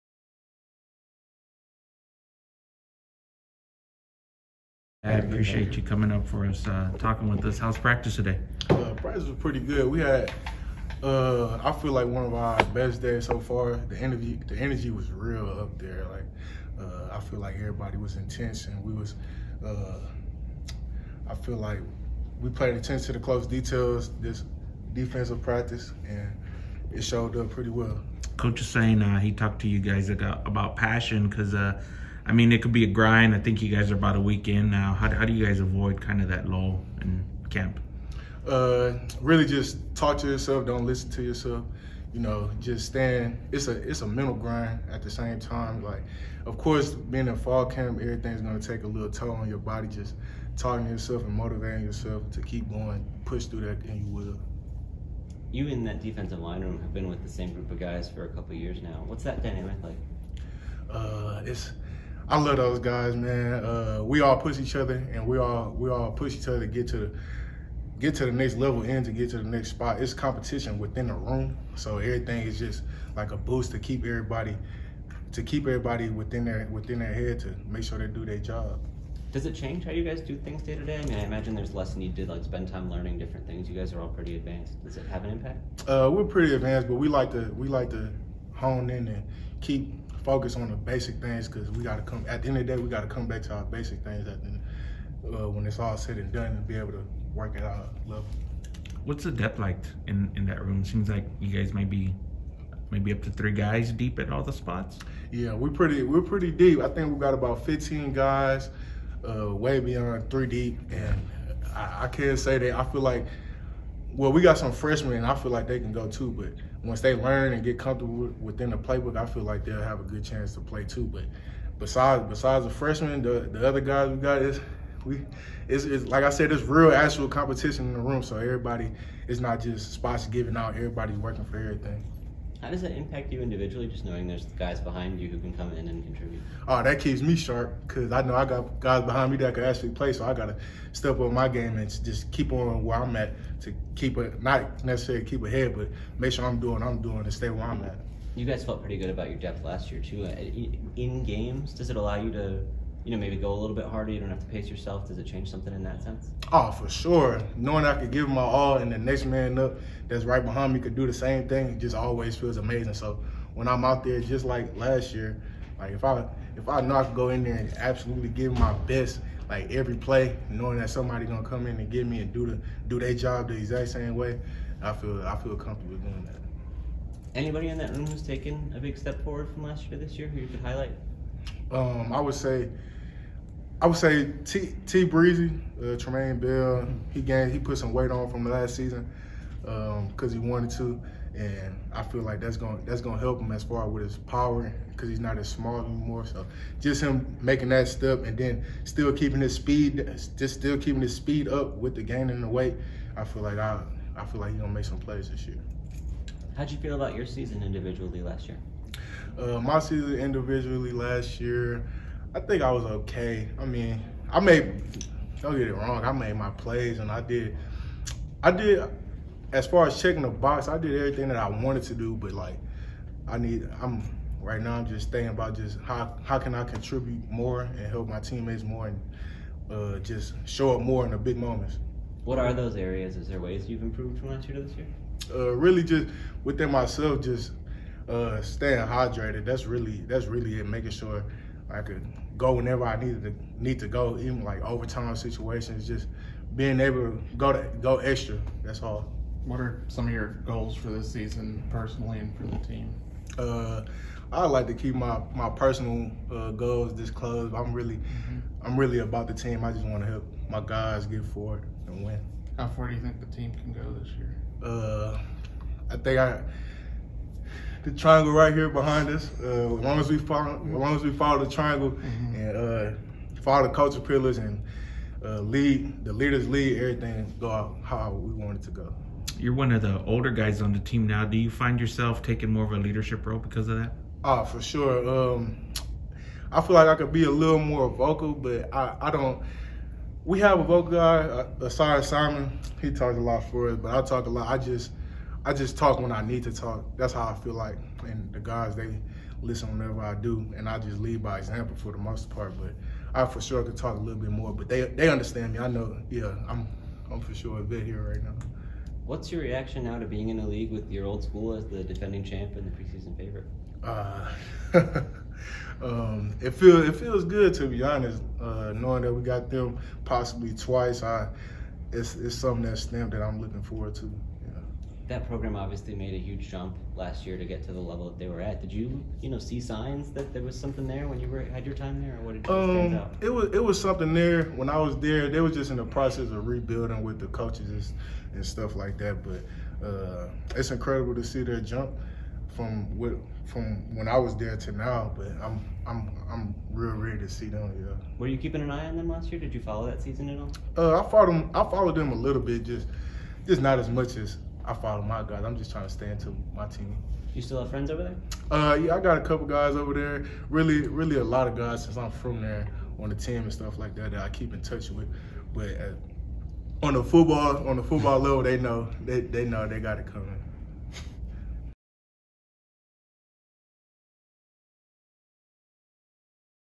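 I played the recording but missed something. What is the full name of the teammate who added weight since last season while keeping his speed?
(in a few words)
Trumane Bell.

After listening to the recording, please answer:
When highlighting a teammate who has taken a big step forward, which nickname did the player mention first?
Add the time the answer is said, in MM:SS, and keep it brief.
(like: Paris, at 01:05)
T Breezy, at 03:04.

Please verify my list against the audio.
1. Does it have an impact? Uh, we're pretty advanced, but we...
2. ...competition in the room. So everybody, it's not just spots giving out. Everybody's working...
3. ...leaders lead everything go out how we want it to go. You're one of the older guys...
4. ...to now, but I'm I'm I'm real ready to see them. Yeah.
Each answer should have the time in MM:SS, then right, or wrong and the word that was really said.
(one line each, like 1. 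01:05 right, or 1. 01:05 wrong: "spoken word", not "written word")
1. 01:24 right
2. 02:07 right
3. 04:36 right
4. 05:44 right.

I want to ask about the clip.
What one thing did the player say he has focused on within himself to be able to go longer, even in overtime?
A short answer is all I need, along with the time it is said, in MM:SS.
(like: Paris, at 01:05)
Staying hydrated, at 03:58.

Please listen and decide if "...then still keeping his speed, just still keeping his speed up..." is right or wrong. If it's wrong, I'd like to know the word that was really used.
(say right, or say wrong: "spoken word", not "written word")
right.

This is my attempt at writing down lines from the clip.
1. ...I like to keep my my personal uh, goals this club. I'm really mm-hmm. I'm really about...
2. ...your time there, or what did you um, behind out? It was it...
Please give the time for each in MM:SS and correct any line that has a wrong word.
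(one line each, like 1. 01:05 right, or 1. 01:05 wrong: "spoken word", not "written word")
1. 04:14 right
2. 05:31 wrong: "stand", not "behind".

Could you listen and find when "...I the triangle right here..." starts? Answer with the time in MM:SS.
04:26.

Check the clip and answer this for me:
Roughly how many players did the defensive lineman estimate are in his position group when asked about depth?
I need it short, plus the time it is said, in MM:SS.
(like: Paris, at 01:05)
15, at 01:47.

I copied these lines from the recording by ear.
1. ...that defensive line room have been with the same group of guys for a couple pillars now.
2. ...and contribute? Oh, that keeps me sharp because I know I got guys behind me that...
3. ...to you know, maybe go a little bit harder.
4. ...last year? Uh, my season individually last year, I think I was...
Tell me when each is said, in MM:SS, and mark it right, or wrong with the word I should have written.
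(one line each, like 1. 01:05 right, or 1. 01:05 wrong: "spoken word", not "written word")
1. 00:55 wrong: "years", not "pillars"
2. 02:15 right
3. 02:32 right
4. 03:28 right.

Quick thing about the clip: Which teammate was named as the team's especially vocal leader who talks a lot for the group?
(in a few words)
Simon.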